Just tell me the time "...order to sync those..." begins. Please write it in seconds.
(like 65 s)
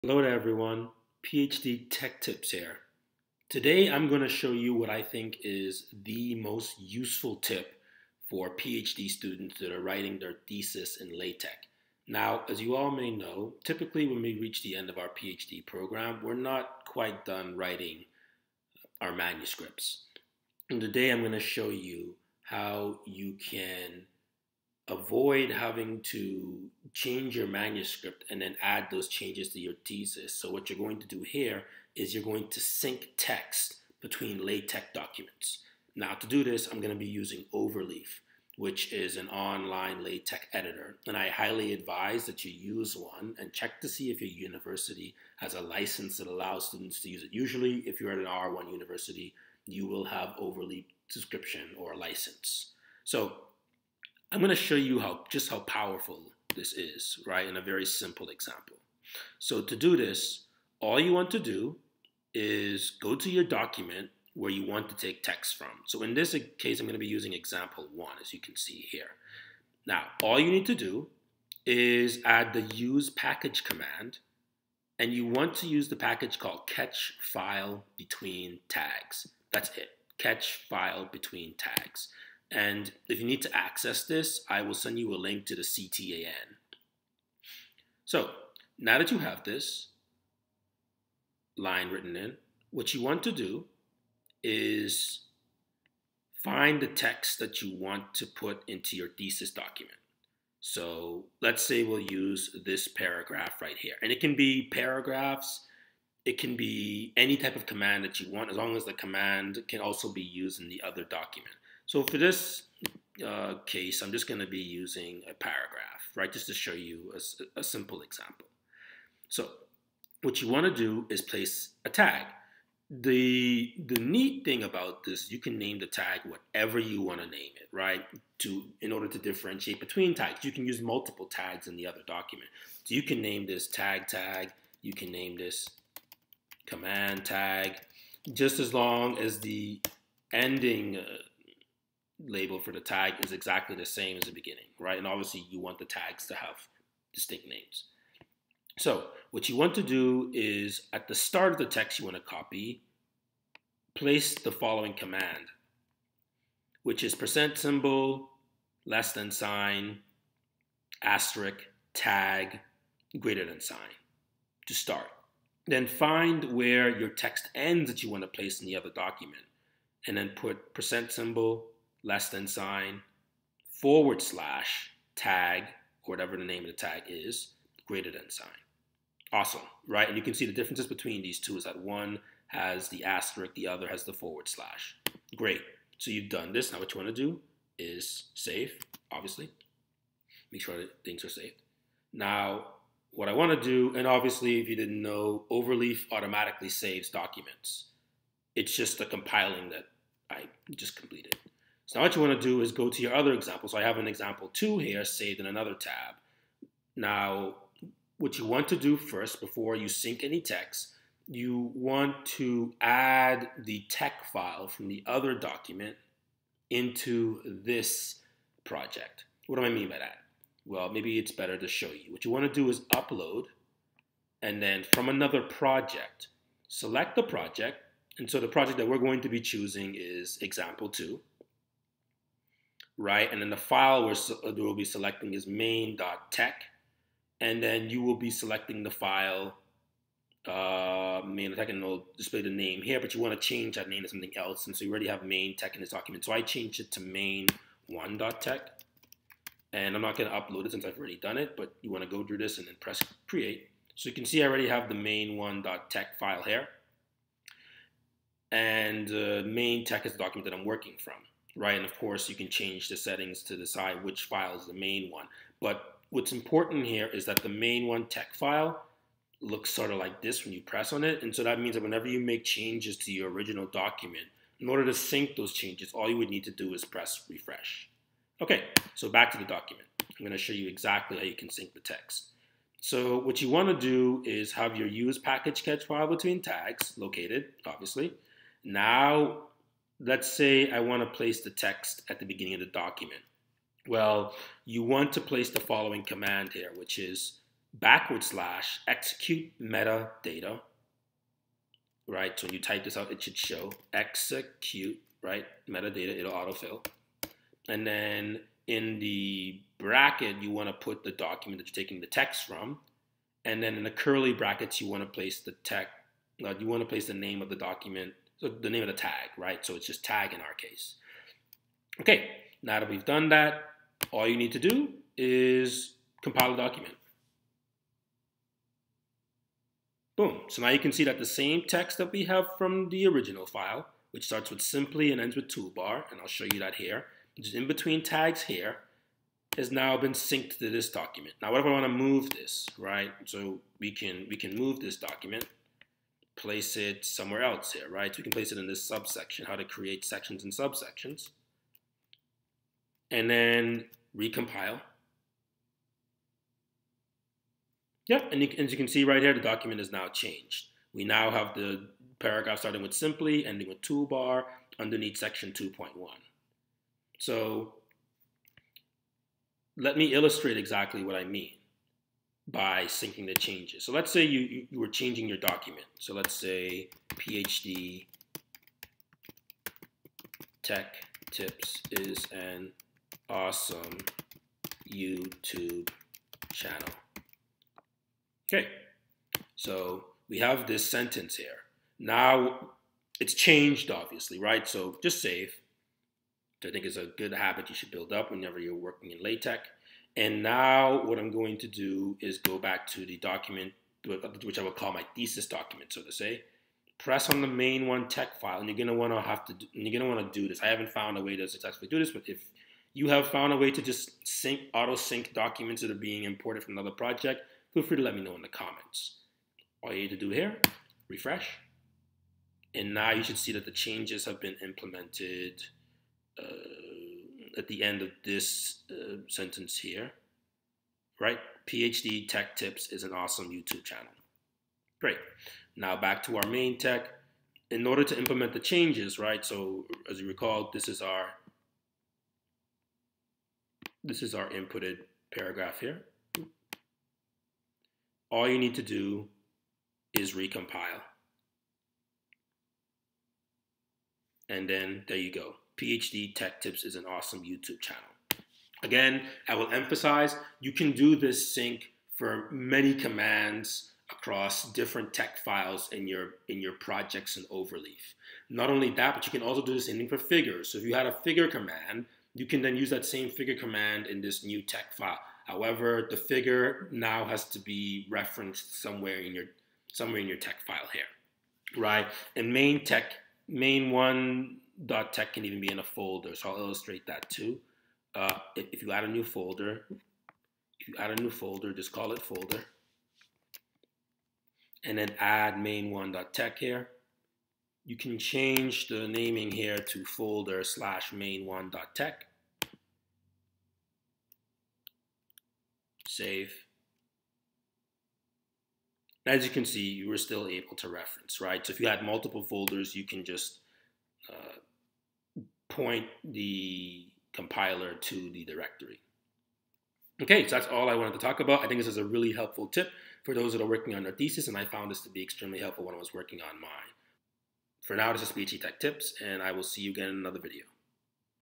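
274 s.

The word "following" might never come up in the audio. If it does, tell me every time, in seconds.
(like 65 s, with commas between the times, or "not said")
154 s, 295 s.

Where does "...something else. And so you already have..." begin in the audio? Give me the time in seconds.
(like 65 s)
244 s.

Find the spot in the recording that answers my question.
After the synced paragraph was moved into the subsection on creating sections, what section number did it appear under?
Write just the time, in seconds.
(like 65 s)
365 s.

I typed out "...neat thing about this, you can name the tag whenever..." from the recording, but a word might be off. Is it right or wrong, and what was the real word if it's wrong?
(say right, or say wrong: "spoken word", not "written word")
wrong: "whatever", not "whenever".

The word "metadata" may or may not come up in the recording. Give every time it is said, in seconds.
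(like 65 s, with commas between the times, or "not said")
299 s, 305 s.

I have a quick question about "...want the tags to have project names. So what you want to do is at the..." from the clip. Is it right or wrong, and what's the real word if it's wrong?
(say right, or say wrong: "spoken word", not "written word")
wrong: "distinct", not "project".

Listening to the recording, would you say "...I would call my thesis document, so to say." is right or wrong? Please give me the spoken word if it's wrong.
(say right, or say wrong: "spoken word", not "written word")
right.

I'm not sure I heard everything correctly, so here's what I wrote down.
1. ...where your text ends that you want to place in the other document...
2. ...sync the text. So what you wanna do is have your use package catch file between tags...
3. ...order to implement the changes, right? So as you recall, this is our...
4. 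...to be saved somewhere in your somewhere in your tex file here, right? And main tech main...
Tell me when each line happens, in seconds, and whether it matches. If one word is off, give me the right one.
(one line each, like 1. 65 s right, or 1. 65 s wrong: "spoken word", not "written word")
1. 166 s right
2. 281 s right
3. 437 s right
4. 477 s wrong: "referenced", not "saved".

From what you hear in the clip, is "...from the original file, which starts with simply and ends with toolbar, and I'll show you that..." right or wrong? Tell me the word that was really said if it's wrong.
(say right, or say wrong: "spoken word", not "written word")
right.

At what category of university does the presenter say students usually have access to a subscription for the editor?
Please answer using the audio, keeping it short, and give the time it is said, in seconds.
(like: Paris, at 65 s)
R1 university, at 48 s.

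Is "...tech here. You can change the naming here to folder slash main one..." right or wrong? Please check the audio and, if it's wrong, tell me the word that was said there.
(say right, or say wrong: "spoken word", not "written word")
right.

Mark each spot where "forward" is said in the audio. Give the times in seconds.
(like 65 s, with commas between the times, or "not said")
173 s, 184 s.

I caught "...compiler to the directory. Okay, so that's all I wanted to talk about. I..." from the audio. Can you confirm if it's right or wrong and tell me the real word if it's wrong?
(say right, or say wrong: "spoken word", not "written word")
right.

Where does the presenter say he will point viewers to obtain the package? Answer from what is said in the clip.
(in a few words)
CTAN.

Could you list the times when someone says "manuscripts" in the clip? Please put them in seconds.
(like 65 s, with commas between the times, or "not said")
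19 s, 27 s.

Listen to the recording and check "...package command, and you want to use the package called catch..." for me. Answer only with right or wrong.
right.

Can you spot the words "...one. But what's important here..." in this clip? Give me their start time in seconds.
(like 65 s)
265 s.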